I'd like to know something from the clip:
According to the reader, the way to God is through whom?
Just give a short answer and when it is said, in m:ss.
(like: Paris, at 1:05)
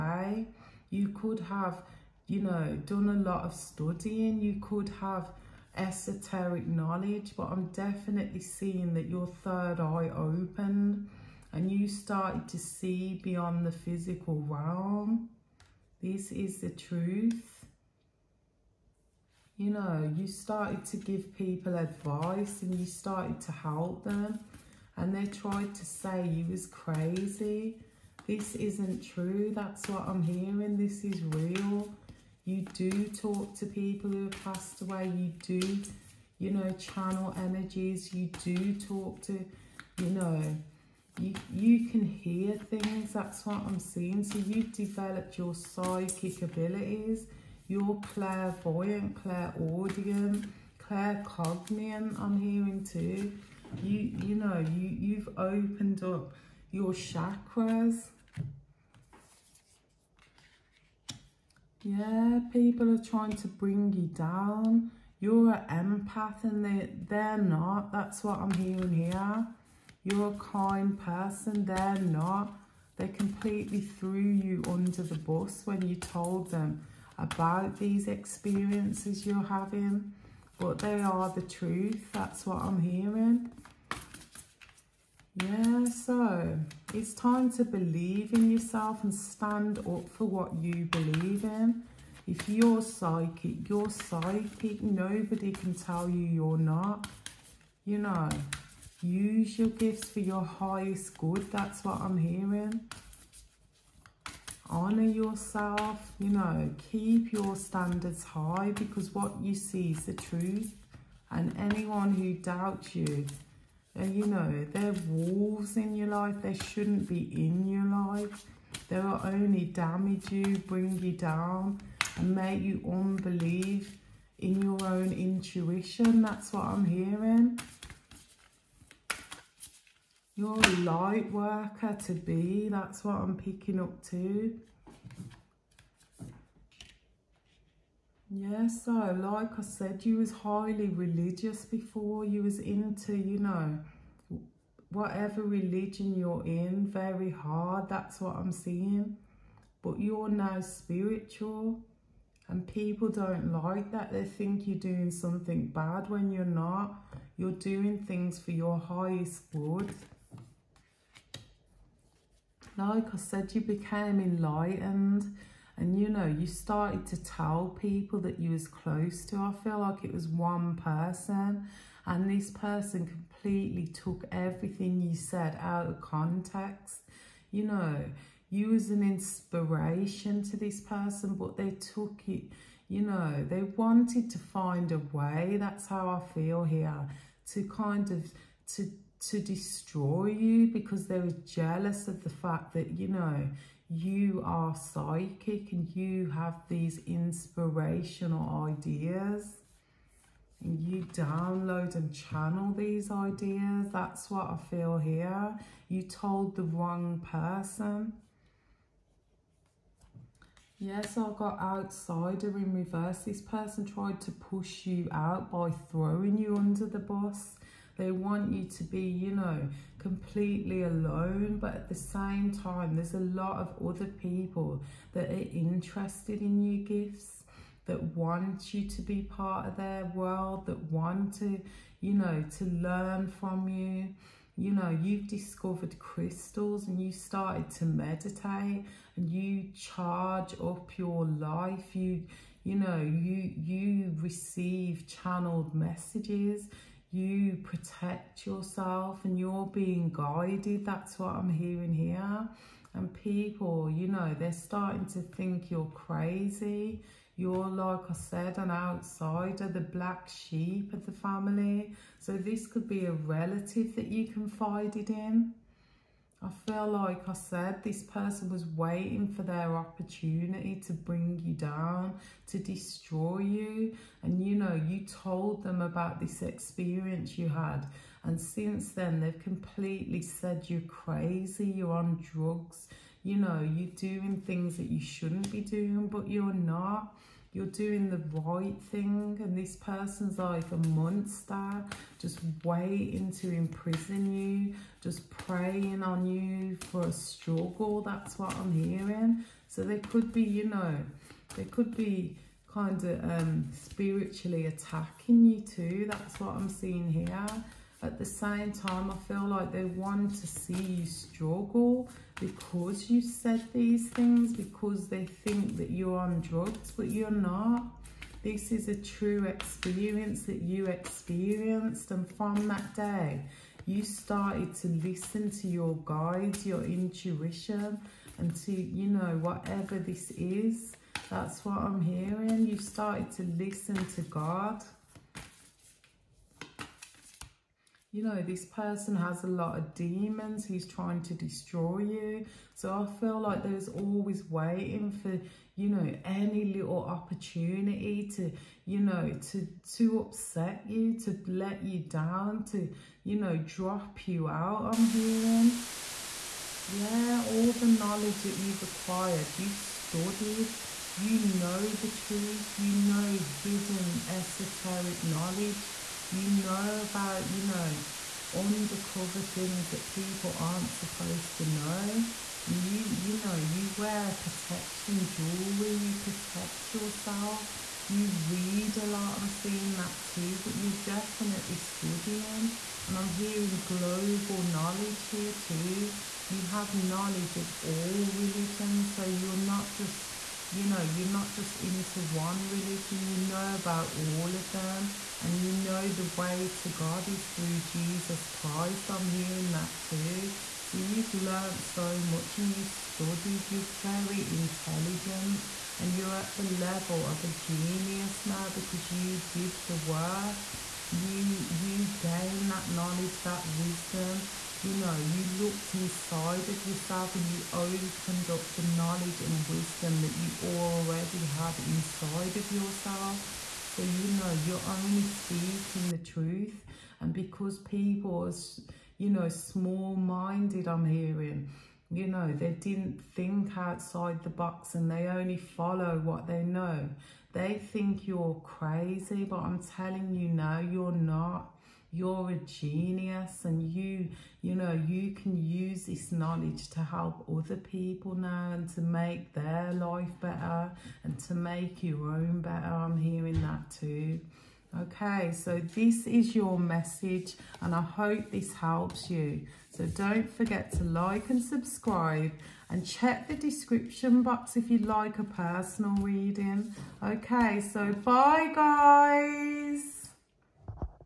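Jesus Christ, at 6:37.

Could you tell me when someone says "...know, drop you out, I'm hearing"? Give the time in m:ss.
5:53.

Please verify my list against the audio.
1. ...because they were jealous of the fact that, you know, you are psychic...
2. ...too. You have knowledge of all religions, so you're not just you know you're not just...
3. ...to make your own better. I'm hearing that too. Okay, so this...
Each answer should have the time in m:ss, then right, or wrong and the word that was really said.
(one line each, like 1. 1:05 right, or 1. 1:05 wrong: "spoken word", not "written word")
1. 3:10 right
2. 6:25 right
3. 7:31 right.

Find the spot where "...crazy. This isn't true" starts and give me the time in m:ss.
0:26.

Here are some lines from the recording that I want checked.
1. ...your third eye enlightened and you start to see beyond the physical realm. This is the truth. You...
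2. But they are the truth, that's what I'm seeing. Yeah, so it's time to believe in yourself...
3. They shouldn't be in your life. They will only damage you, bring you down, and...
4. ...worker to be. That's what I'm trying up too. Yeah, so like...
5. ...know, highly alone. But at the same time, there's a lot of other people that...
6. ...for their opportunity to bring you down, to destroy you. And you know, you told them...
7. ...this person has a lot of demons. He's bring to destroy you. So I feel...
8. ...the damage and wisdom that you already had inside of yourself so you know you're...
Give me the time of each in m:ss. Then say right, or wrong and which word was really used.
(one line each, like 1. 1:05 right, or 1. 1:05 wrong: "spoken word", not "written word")
1. 0:09 wrong: "opened", not "enlightened"
2. 1:20 wrong: "hearing", not "seeing"
3. 1:56 right
4. 2:11 wrong: "picking", not "trying"
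5. 3:39 wrong: "completely", not "highly"
6. 4:29 right
7. 5:38 wrong: "trying", not "bring"
8. 6:58 wrong: "knowledge", not "damage".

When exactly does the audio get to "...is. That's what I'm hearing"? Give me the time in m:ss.
5:30.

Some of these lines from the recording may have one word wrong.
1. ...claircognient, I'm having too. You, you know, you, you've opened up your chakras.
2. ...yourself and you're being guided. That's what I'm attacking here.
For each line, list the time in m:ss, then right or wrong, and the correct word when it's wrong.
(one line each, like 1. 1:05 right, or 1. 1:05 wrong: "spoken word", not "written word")
1. 0:50 wrong: "hearing", not "having"
2. 4:08 wrong: "hearing", not "attacking".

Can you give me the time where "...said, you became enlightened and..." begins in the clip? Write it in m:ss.
2:43.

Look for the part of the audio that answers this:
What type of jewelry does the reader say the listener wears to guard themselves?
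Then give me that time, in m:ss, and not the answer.
6:14.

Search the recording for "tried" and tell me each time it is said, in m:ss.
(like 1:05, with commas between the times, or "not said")
0:25, 3:33.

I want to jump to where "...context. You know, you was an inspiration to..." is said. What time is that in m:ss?
2:55.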